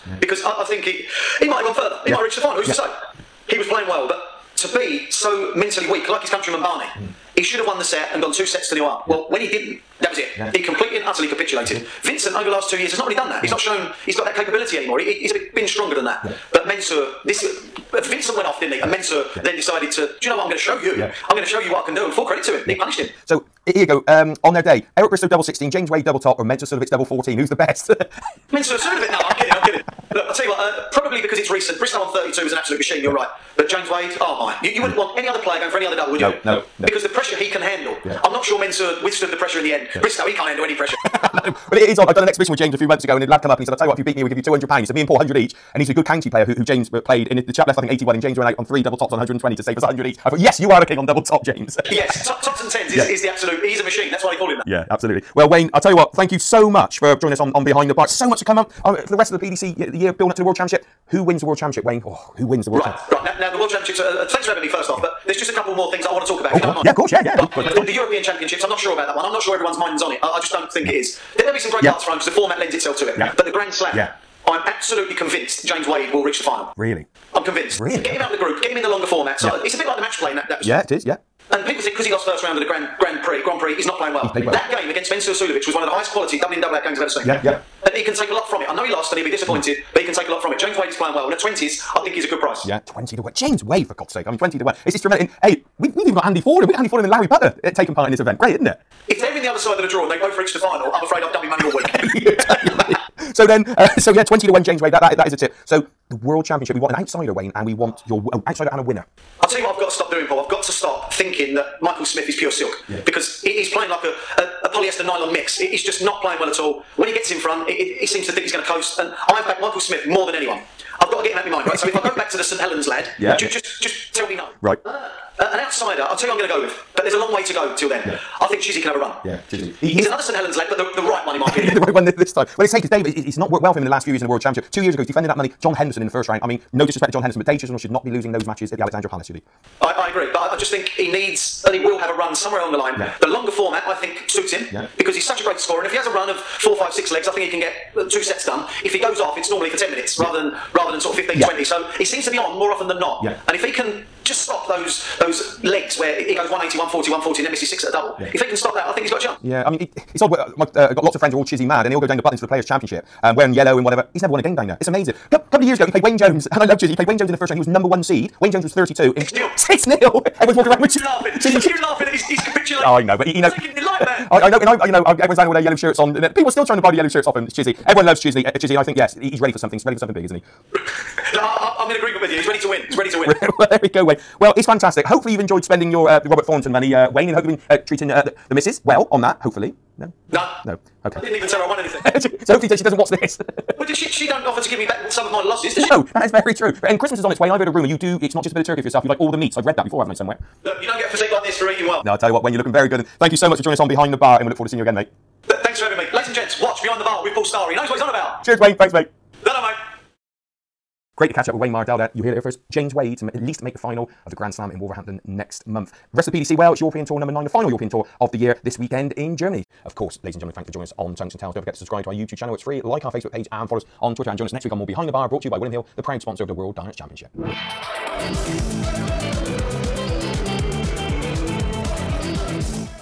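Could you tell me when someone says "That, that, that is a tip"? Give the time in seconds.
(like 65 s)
104 s.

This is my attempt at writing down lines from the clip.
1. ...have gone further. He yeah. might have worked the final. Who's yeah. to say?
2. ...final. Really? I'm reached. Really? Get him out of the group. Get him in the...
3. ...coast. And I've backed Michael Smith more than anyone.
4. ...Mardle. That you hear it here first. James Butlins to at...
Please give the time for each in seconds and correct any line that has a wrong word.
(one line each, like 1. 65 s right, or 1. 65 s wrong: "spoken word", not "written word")
1. 1 s wrong: "reached", not "worked"
2. 76 s wrong: "convinced", not "reached"
3. 118 s right
4. 211 s wrong: "Wade", not "Butlins".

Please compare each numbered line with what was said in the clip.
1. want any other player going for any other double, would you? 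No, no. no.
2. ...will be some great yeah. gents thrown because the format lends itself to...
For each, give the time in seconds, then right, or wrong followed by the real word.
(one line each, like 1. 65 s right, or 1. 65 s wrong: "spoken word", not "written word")
1. 34 s right
2. 71 s wrong: "darts", not "gents".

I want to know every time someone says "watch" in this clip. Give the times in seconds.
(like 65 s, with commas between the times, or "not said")
192 s, 206 s.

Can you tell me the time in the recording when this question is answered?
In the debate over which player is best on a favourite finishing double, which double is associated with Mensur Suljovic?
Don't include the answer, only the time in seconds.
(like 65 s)
26 s.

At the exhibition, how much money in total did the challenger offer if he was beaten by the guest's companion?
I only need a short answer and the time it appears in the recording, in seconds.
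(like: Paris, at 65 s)
£200, at 44 s.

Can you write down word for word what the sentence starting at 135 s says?
John Henderson in the first round.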